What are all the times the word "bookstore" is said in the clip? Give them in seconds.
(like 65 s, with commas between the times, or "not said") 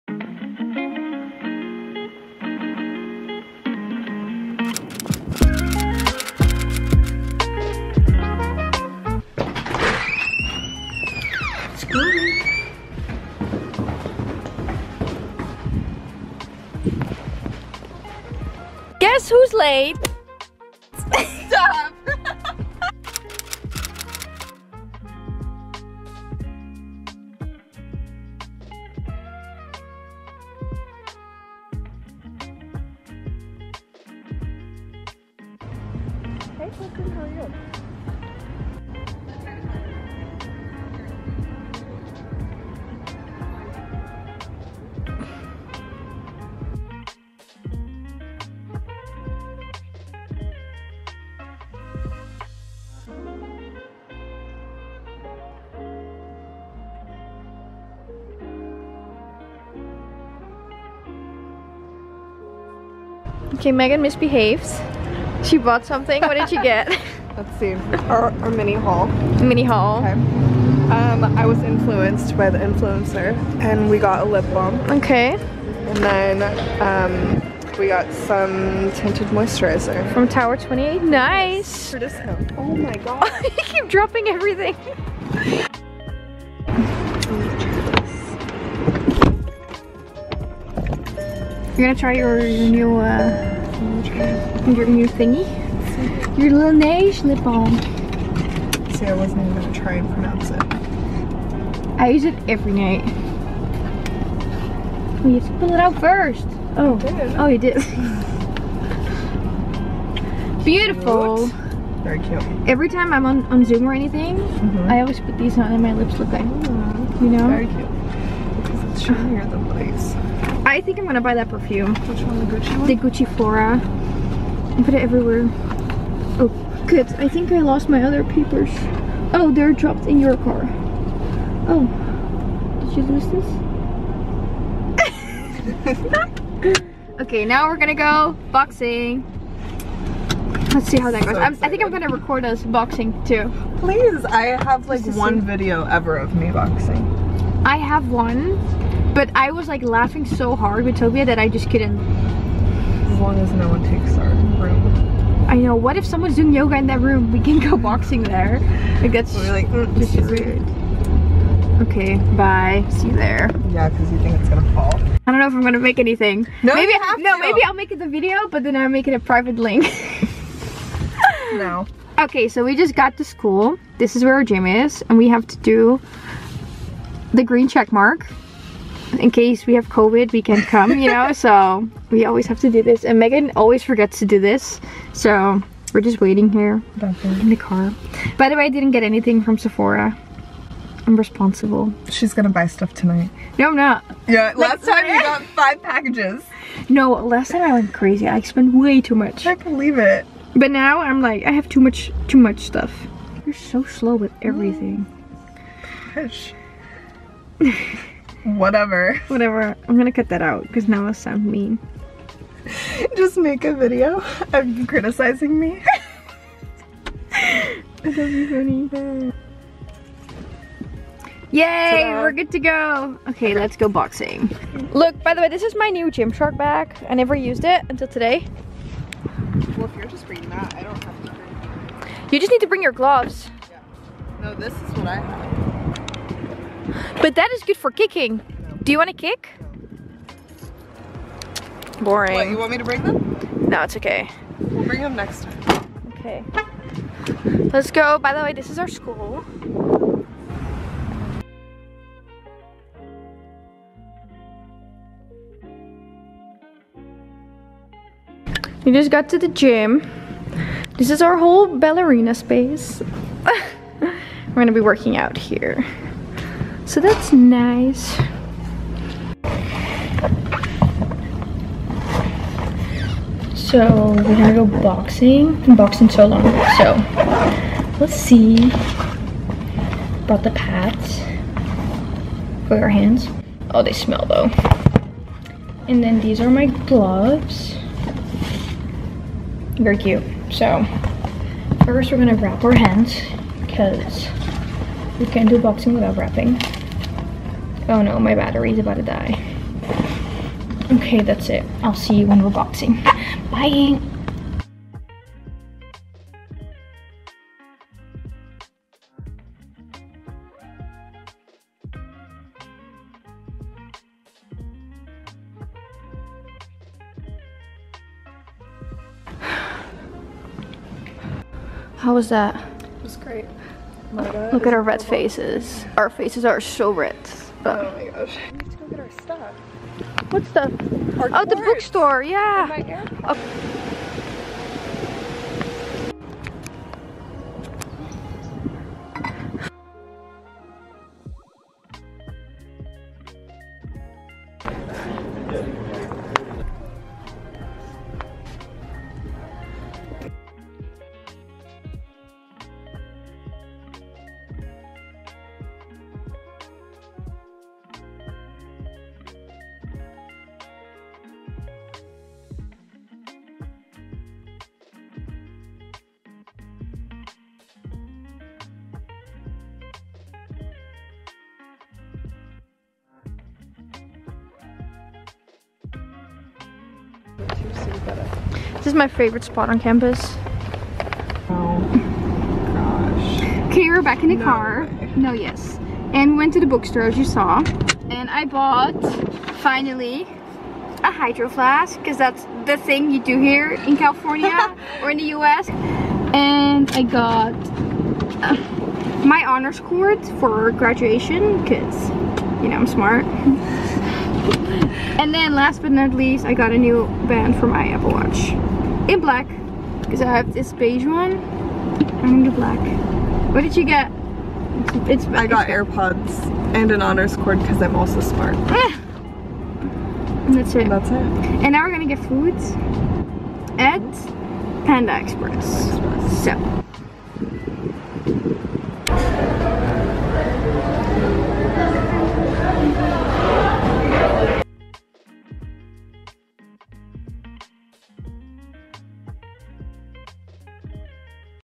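331 s, 386 s.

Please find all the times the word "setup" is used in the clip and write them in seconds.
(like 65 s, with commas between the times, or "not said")
not said.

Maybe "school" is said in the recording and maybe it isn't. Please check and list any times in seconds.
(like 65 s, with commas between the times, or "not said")
173 s, 248 s.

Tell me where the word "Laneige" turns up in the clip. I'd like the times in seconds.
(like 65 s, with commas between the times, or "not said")
96 s.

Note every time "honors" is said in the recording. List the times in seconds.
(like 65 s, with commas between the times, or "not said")
399 s, 417 s.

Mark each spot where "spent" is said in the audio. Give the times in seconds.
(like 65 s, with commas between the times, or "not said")
198 s.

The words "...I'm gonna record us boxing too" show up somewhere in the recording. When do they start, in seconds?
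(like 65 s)
141 s.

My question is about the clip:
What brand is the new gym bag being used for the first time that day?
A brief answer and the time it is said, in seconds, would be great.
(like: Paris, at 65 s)
Gymshark, at 226 s.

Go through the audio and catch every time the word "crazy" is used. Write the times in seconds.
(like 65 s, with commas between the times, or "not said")
197 s.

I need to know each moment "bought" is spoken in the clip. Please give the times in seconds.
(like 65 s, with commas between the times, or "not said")
65 s, 388 s.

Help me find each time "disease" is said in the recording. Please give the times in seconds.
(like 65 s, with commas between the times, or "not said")
not said.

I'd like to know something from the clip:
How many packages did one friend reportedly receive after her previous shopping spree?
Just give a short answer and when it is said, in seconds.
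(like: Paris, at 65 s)
5, at 195 s.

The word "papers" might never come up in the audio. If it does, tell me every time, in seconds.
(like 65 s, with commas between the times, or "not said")
128 s.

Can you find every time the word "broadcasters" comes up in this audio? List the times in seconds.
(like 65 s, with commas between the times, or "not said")
not said.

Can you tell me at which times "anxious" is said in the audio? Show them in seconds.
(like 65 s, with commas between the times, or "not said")
not said.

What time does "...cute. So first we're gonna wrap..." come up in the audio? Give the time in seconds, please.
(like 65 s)
289 s.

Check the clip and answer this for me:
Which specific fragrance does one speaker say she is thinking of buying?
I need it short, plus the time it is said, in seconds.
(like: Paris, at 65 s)
Gucci Flora, at 122 s.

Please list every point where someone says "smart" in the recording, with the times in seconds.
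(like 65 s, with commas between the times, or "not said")
402 s, 418 s.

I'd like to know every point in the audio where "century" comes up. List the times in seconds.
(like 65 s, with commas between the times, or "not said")
not said.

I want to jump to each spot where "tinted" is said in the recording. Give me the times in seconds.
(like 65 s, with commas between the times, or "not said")
78 s.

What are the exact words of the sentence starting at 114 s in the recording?
I always put these on and my lips look like, Ooh, you know?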